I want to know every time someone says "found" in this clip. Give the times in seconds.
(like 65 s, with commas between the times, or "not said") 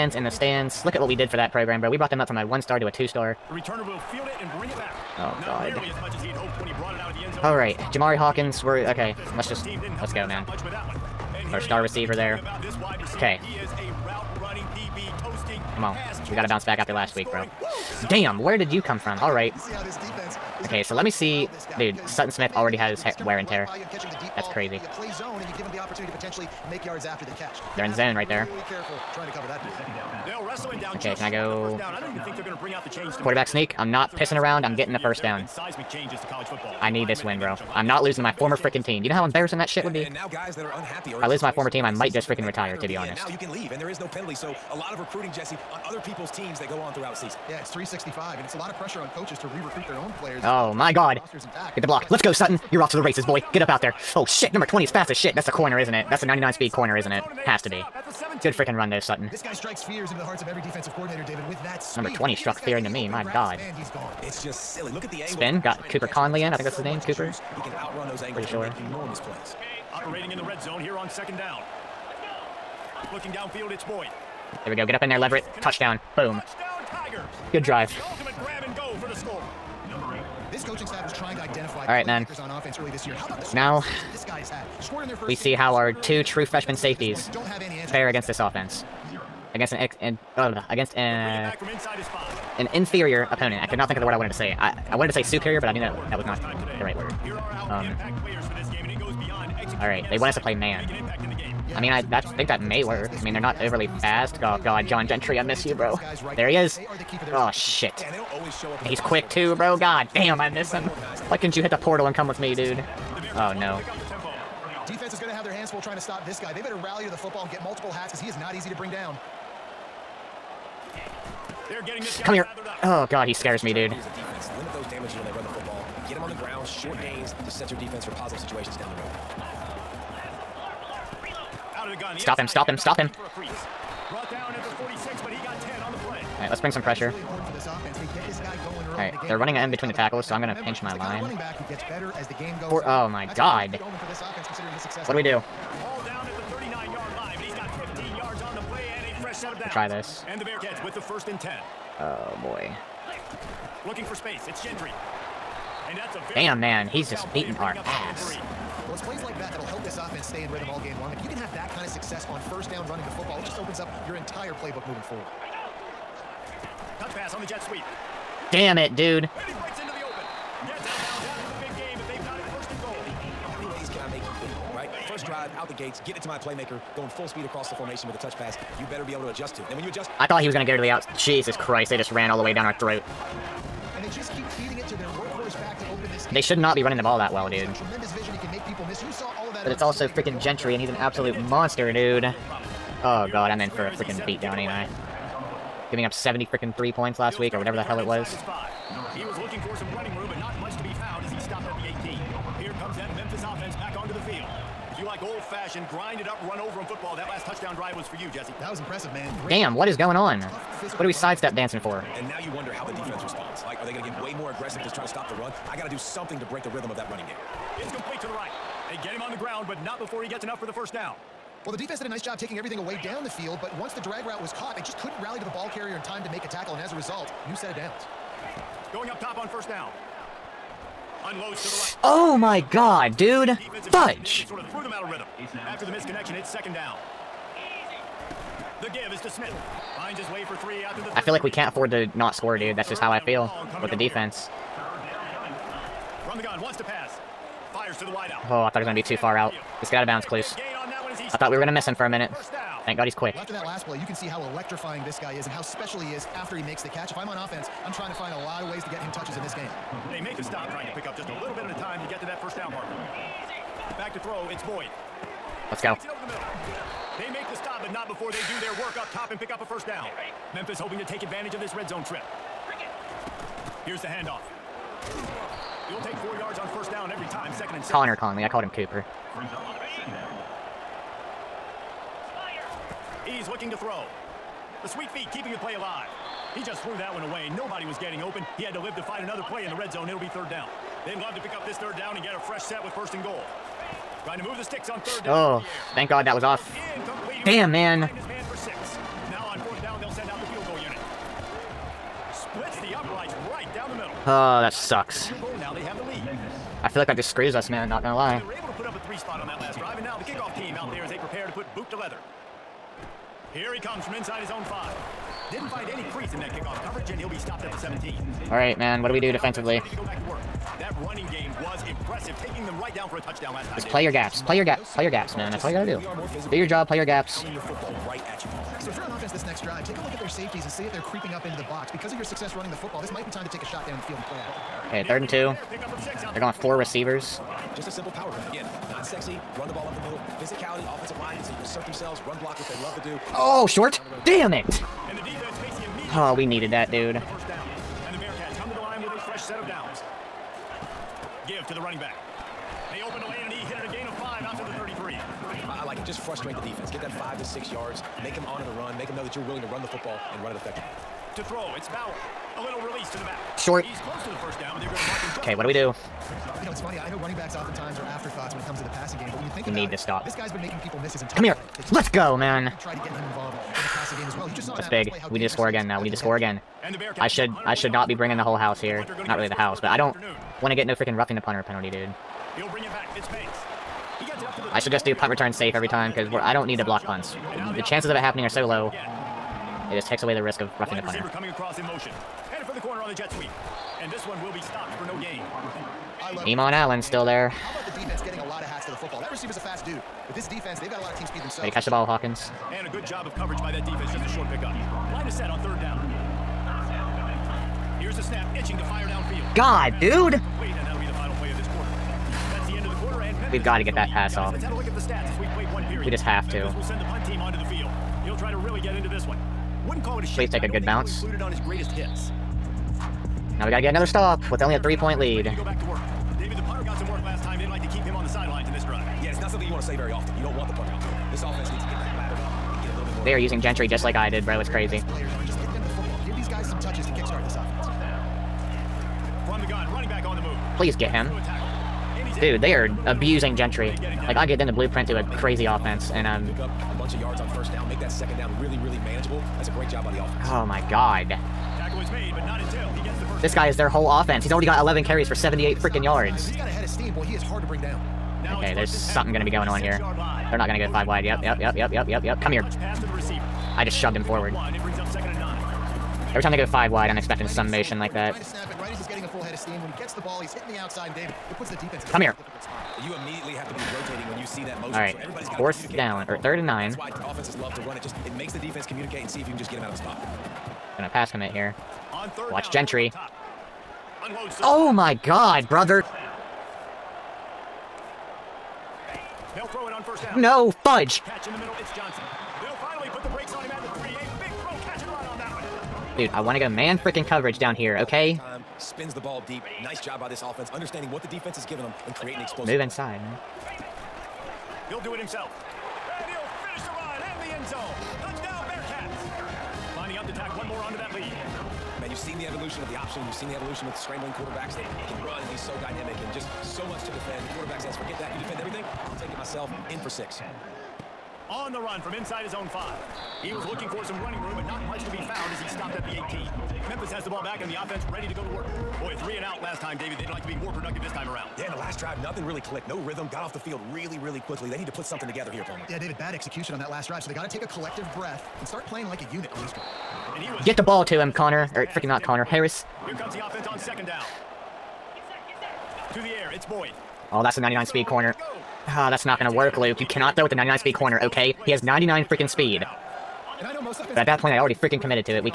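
525 s.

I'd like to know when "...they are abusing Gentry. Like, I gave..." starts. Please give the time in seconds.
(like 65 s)
442 s.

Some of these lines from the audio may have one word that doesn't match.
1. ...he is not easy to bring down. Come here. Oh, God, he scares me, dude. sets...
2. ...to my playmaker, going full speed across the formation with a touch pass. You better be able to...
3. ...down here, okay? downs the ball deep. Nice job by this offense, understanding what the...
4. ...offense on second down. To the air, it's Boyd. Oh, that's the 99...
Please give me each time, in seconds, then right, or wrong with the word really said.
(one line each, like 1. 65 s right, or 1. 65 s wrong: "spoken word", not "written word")
1. 118 s right
2. 176 s right
3. 497 s wrong: "spins", not "downs"
4. 543 s right.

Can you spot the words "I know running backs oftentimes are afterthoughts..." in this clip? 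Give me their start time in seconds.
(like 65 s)
366 s.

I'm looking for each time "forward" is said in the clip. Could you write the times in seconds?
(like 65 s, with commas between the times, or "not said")
165 s, 464 s.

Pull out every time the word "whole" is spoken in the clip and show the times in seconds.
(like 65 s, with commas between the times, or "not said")
378 s, 453 s.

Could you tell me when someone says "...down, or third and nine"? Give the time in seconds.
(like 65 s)
475 s.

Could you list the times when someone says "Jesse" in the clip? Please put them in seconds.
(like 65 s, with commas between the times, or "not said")
45 s, 208 s.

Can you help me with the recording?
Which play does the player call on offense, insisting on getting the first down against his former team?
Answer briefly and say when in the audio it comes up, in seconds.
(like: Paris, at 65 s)
Quarterback sneak, at 33 s.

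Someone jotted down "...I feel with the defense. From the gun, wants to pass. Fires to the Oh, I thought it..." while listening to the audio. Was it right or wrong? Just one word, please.
right.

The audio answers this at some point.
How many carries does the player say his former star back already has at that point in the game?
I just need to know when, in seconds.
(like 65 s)
454 s.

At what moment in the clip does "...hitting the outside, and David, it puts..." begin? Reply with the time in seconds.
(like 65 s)
470 s.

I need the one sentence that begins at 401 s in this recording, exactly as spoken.
Way to catch the ball, Hawkins.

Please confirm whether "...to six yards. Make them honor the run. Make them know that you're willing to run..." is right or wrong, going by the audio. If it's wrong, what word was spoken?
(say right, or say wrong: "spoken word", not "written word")
right.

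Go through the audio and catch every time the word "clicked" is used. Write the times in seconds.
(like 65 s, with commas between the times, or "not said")
532 s.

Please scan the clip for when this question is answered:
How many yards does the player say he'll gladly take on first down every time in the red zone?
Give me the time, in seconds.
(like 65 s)
276 s.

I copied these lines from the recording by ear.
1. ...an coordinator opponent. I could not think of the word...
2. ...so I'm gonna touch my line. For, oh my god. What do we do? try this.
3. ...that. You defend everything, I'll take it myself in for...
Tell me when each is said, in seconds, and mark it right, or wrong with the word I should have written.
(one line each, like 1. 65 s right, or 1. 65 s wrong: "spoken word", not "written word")
1. 92 s wrong: "inferior", not "coordinator"
2. 140 s wrong: "pinch", not "touch"
3. 518 s right.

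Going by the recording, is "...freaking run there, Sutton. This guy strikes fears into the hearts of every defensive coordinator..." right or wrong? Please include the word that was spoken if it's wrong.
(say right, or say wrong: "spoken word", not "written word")
right.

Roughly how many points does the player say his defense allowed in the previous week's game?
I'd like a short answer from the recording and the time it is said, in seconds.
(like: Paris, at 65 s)
73, at 196 s.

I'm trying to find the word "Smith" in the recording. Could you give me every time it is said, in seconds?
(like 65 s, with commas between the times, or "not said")
22 s, 239 s.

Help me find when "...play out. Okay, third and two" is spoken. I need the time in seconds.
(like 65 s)
334 s.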